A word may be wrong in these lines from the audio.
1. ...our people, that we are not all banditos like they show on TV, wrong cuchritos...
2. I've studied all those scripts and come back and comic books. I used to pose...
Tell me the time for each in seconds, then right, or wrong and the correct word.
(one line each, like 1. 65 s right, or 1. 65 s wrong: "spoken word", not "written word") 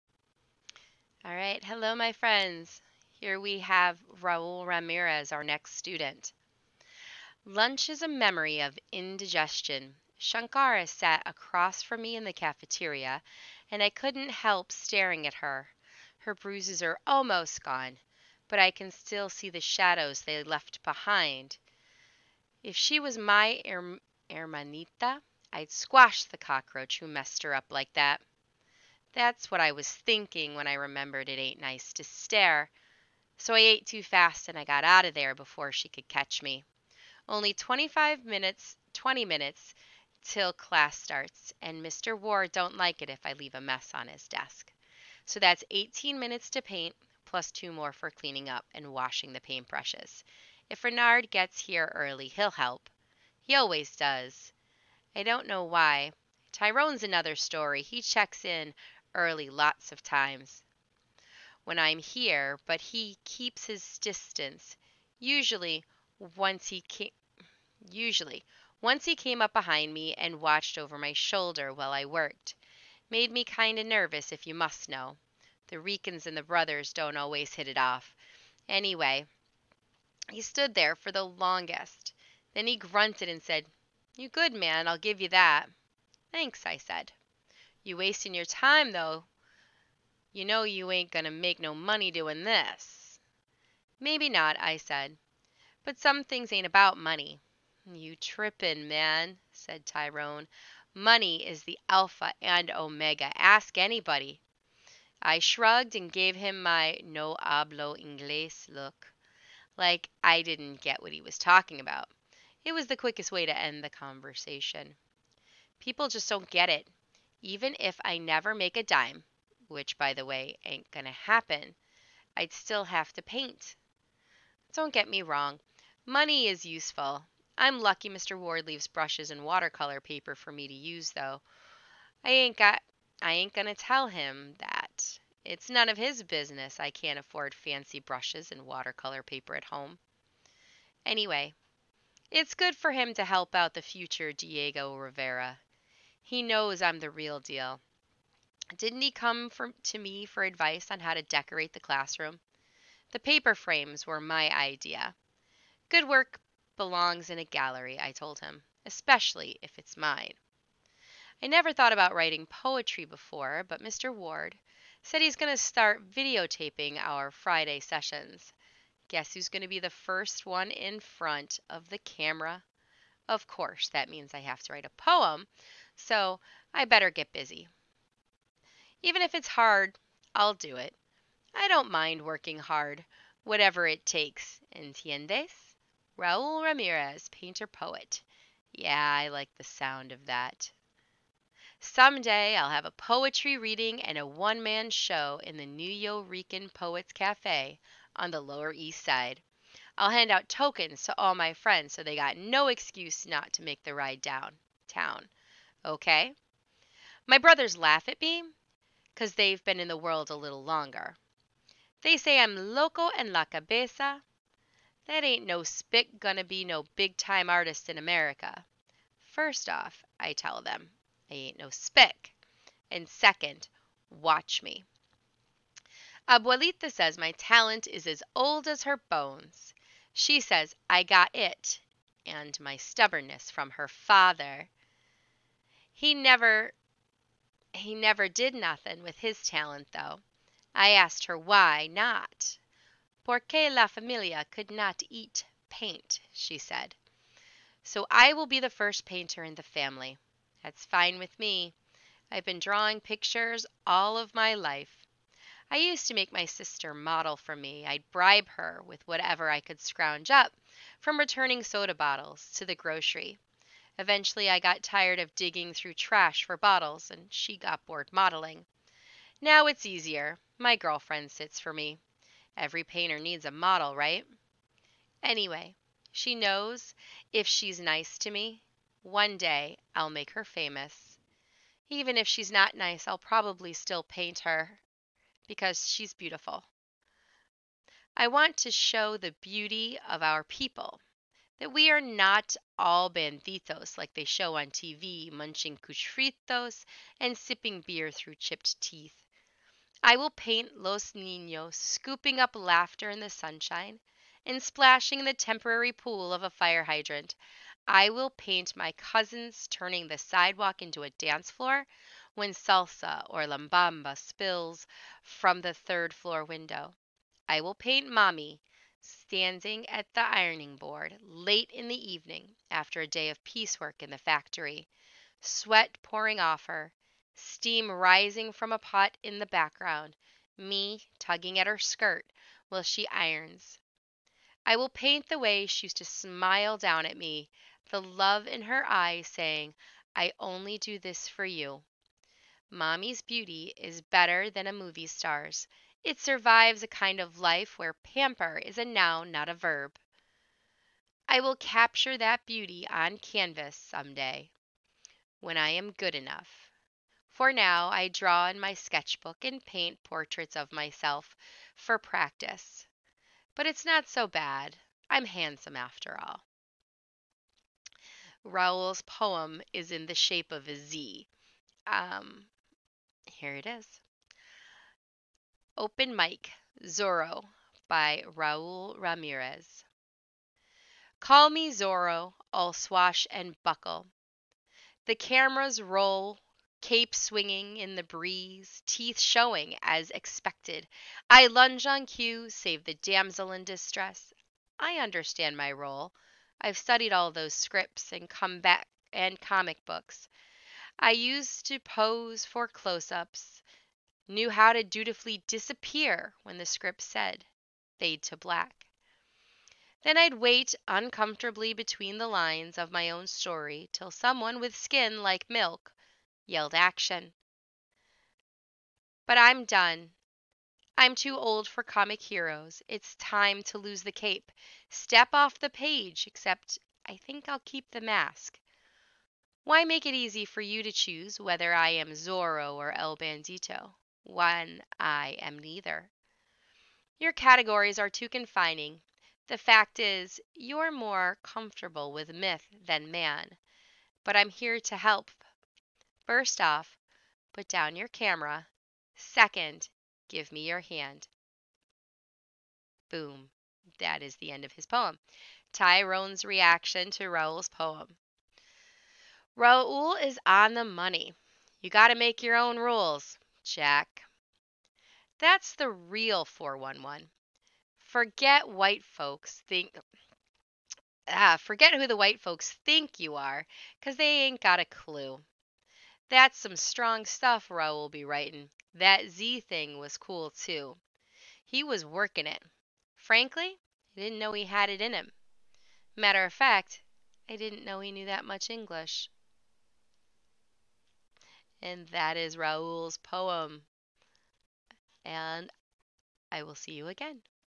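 1. 290 s wrong: "munching", not "wrong"
2. 396 s right.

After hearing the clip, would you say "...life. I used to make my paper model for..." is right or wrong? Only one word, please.
wrong.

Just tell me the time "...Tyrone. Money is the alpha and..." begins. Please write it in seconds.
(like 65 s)
99 s.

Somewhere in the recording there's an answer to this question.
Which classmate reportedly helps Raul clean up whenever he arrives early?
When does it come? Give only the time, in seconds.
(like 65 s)
50 s.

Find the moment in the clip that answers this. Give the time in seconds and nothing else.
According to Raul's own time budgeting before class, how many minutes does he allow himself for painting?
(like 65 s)
45 s.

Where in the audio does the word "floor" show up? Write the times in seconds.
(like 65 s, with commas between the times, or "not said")
311 s, 316 s.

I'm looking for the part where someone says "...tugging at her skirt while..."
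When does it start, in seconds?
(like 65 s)
331 s.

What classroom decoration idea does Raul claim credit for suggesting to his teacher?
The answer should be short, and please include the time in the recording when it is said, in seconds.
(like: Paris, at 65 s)
Paper frames, at 153 s.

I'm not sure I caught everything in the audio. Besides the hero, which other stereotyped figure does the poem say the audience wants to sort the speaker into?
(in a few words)
El Bandito.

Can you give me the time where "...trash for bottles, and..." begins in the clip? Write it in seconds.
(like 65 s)
265 s.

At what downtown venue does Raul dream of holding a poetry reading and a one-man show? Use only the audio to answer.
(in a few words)
Nuyorican Poets Cafe.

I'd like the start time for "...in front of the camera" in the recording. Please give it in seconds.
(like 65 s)
170 s.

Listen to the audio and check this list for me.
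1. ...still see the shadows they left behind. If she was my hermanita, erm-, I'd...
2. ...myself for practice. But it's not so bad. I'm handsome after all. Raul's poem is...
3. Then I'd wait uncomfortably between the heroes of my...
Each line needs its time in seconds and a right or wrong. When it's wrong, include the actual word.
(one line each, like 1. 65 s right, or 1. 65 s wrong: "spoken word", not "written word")
1. 18 s right
2. 360 s right
3. 410 s wrong: "lines", not "heroes".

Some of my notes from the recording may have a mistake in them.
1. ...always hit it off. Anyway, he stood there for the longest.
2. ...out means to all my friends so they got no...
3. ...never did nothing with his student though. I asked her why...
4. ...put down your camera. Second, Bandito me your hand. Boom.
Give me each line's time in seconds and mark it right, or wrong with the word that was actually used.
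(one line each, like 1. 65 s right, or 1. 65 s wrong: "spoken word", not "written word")
1. 77 s right
2. 200 s wrong: "tokens", not "means"
3. 237 s wrong: "talent", not "student"
4. 447 s wrong: "Give", not "Bandito".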